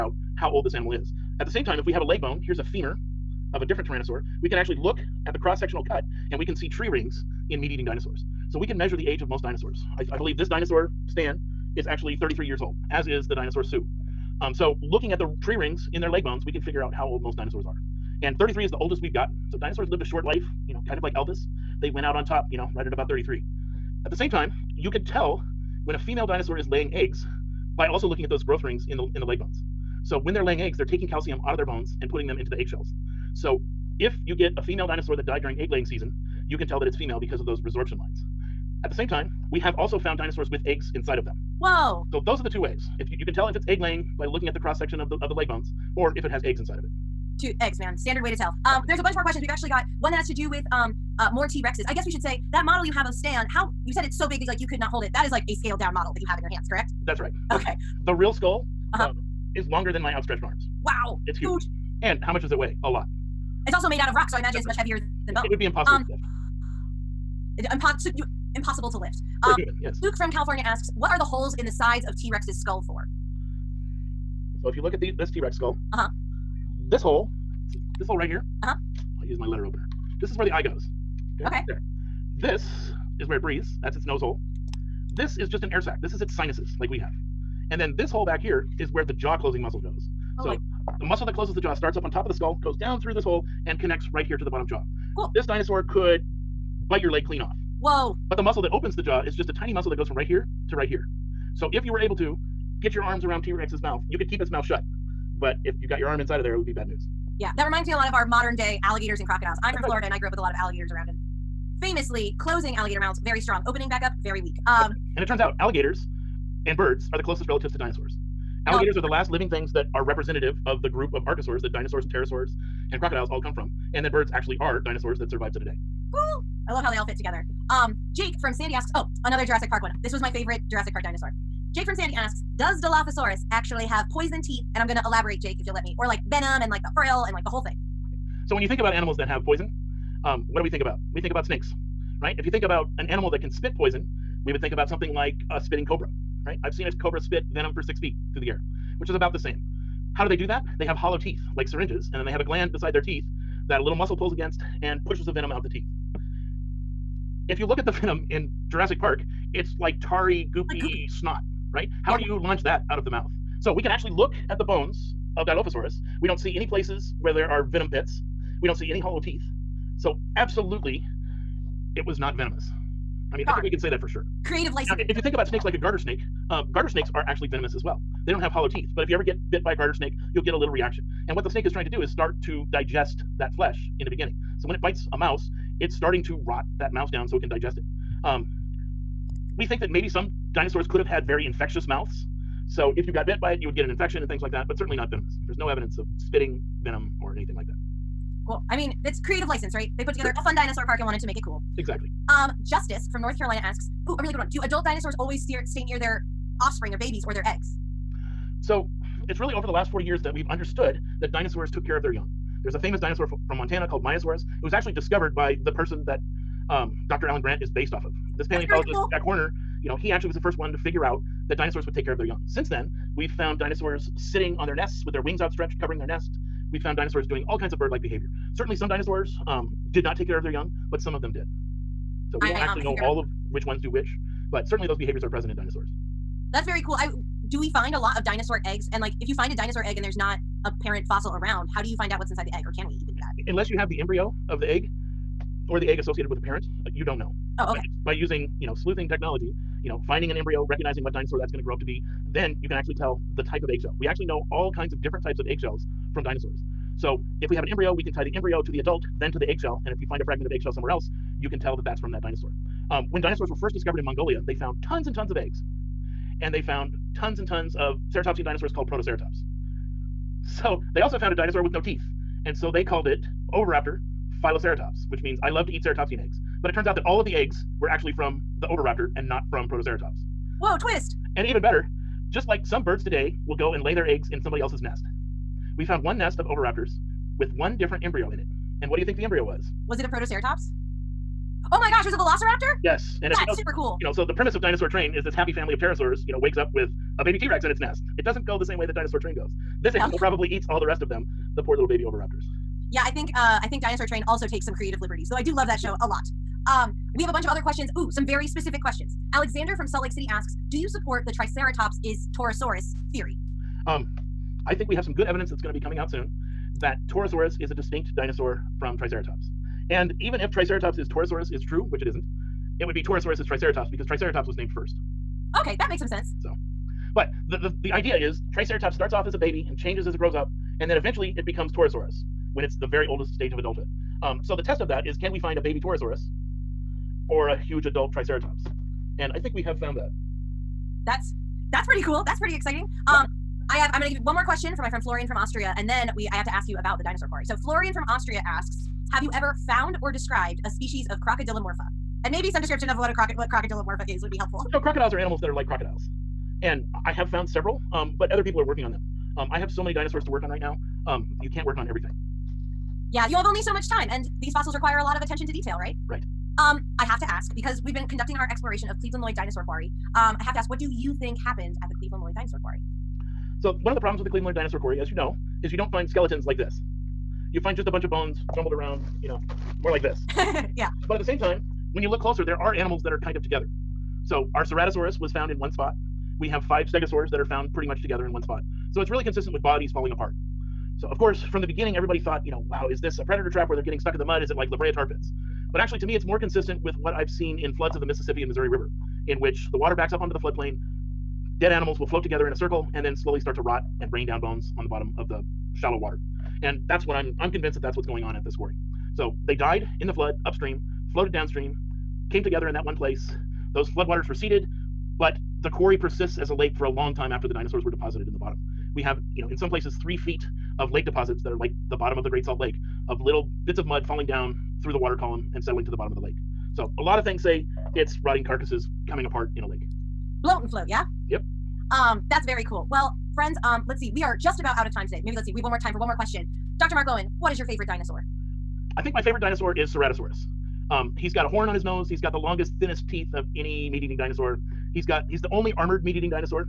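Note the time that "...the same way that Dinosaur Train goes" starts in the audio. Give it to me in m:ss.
4:58.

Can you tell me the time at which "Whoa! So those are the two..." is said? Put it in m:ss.
0:41.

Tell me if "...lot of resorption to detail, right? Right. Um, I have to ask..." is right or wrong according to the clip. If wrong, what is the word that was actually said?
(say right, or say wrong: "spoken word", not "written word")
wrong: "attention", not "resorption".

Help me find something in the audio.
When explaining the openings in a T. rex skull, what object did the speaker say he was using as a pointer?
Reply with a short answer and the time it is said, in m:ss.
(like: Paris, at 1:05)
letter opener, at 1:19.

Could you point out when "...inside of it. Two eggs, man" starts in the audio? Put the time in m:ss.
0:46.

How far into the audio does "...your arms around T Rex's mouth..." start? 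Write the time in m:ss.
1:42.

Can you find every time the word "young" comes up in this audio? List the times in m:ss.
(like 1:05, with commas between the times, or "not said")
3:32, 3:42, 3:50.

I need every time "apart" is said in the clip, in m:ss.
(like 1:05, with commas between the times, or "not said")
6:30, 7:09.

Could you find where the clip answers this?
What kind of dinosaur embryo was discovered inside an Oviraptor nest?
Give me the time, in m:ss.
4:52.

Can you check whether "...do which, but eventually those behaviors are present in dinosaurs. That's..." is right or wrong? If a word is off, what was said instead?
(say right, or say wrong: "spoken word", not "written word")
wrong: "certainly", not "eventually".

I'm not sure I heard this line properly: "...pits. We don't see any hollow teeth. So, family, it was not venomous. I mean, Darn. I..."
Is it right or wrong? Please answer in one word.
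wrong.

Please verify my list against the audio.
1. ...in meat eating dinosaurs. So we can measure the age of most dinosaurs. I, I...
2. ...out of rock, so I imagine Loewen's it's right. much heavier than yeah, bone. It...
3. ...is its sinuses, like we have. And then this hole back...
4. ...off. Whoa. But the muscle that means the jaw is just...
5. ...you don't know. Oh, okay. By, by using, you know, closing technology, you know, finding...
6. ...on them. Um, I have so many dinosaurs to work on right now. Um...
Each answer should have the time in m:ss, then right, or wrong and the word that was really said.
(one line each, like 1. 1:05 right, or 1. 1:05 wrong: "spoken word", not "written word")
1. 0:07 right
2. 1:03 wrong: "That", not "Loewen"
3. 1:26 right
4. 1:37 wrong: "opens", not "means"
5. 4:06 wrong: "sleuthing", not "closing"
6. 5:58 right.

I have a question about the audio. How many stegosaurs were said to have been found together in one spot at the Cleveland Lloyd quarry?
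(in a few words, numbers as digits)
5.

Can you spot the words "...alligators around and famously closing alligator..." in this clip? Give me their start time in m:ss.
1:50.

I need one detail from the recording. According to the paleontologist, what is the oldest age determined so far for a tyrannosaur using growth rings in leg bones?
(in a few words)
33.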